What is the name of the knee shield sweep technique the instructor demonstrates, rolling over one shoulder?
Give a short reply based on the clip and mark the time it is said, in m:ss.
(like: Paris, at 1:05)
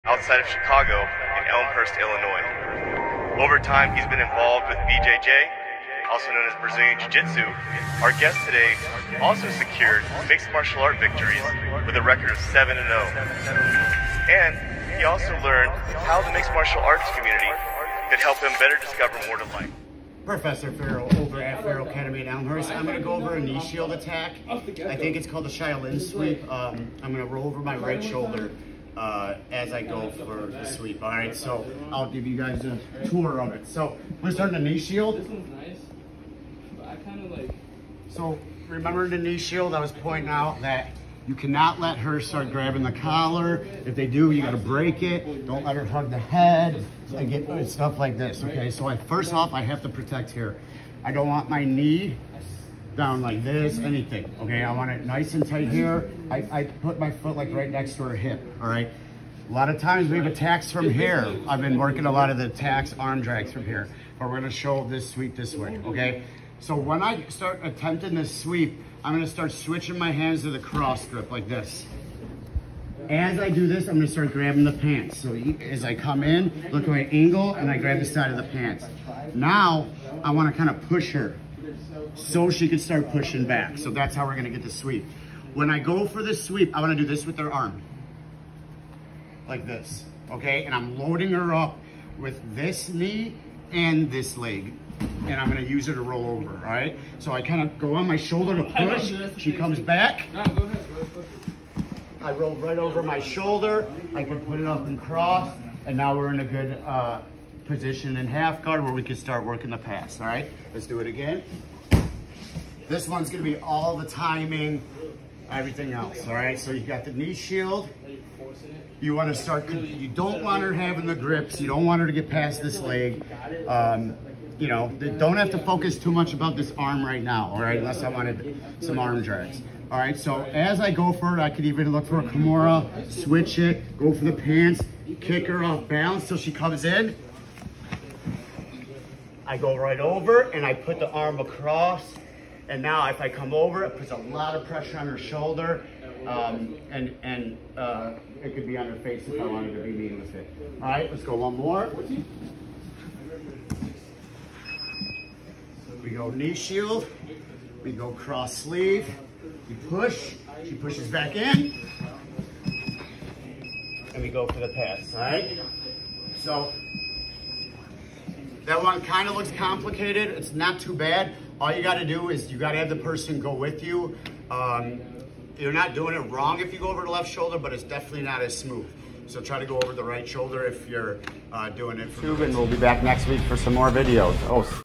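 Shaolin sweep, at 0:25.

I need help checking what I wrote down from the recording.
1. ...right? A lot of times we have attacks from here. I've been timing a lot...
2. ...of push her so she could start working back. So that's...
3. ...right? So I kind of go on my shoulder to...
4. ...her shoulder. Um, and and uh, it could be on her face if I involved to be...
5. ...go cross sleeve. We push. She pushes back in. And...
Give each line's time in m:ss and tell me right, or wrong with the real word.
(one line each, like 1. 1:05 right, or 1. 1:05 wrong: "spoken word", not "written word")
1. 0:58 wrong: "working", not "timing"
2. 1:20 wrong: "pushing", not "working"
3. 1:36 right
4. 2:25 wrong: "wanted", not "involved"
5. 2:37 right.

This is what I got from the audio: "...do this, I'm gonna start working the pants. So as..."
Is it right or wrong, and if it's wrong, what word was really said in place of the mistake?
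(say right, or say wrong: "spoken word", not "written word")
wrong: "grabbing", not "working".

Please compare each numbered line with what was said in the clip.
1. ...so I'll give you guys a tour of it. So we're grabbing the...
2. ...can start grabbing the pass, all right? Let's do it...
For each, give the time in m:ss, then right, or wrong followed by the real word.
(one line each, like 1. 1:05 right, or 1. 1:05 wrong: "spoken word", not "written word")
1. 0:31 wrong: "starting", not "grabbing"
2. 1:49 wrong: "working", not "grabbing".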